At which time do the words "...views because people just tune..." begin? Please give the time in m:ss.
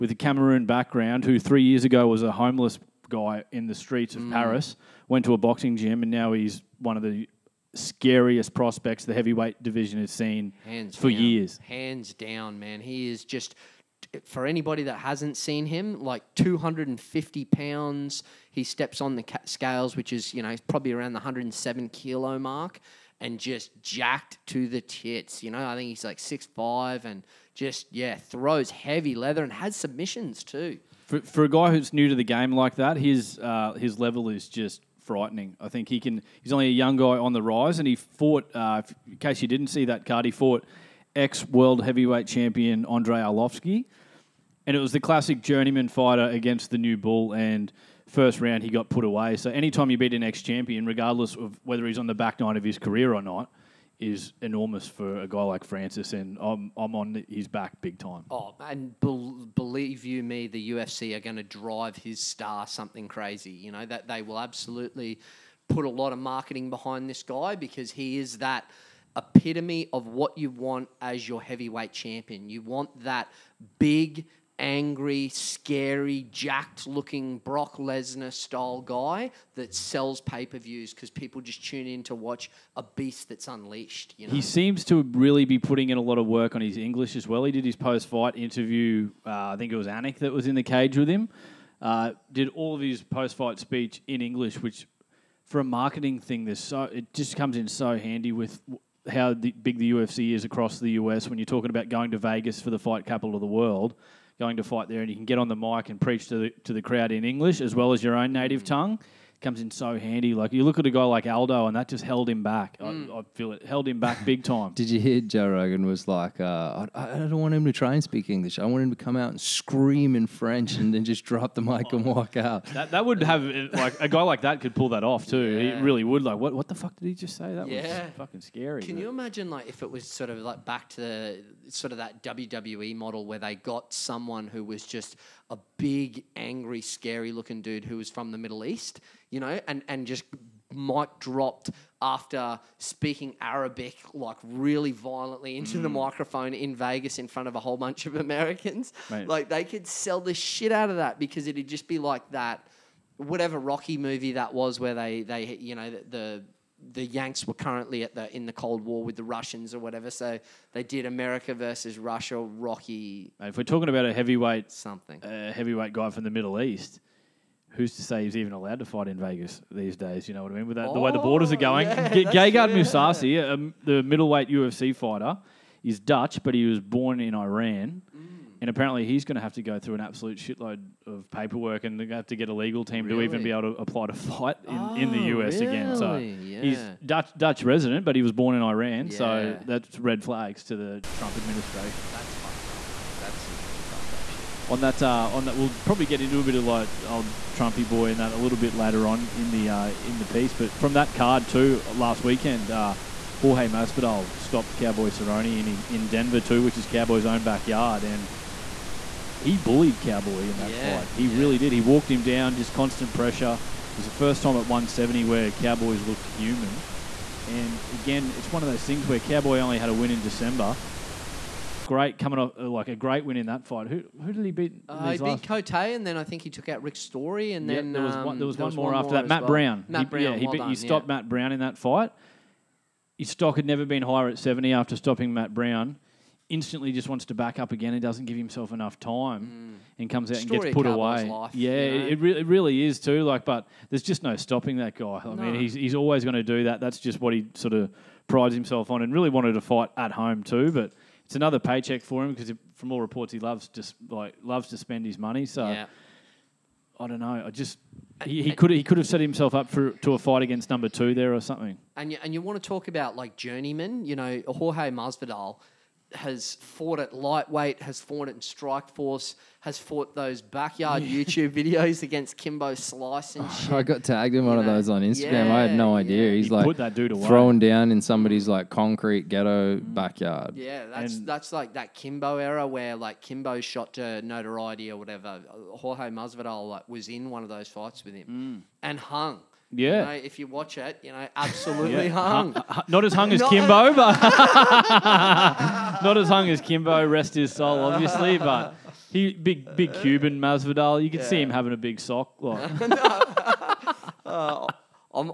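1:20.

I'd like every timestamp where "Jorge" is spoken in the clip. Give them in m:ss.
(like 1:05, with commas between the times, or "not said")
3:23, 4:24, 4:45.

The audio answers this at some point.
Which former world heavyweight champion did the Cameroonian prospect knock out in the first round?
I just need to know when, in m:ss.
0:42.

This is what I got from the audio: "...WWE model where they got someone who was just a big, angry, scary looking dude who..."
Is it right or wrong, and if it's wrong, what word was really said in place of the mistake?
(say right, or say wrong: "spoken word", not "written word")
right.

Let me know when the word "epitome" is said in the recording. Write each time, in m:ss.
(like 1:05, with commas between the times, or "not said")
1:09.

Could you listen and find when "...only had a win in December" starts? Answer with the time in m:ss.
3:39.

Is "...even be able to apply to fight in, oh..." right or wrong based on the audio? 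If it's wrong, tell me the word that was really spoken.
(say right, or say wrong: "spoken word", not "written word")
right.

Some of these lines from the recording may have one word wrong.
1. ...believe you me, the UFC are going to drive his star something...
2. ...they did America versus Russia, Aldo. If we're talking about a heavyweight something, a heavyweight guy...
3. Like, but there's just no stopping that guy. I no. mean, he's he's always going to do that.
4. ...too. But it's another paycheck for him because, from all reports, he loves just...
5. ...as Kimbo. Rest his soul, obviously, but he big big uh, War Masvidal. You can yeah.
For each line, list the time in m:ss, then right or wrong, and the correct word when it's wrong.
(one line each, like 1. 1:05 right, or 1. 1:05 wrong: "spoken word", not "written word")
1. 0:59 right
2. 2:40 wrong: "Rocky", not "Aldo"
3. 4:03 right
4. 4:10 right
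5. 4:56 wrong: "Cuban", not "War".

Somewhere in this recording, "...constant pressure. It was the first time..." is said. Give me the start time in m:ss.
3:32.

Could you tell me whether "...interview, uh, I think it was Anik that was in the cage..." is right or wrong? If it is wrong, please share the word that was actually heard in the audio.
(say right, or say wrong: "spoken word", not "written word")
right.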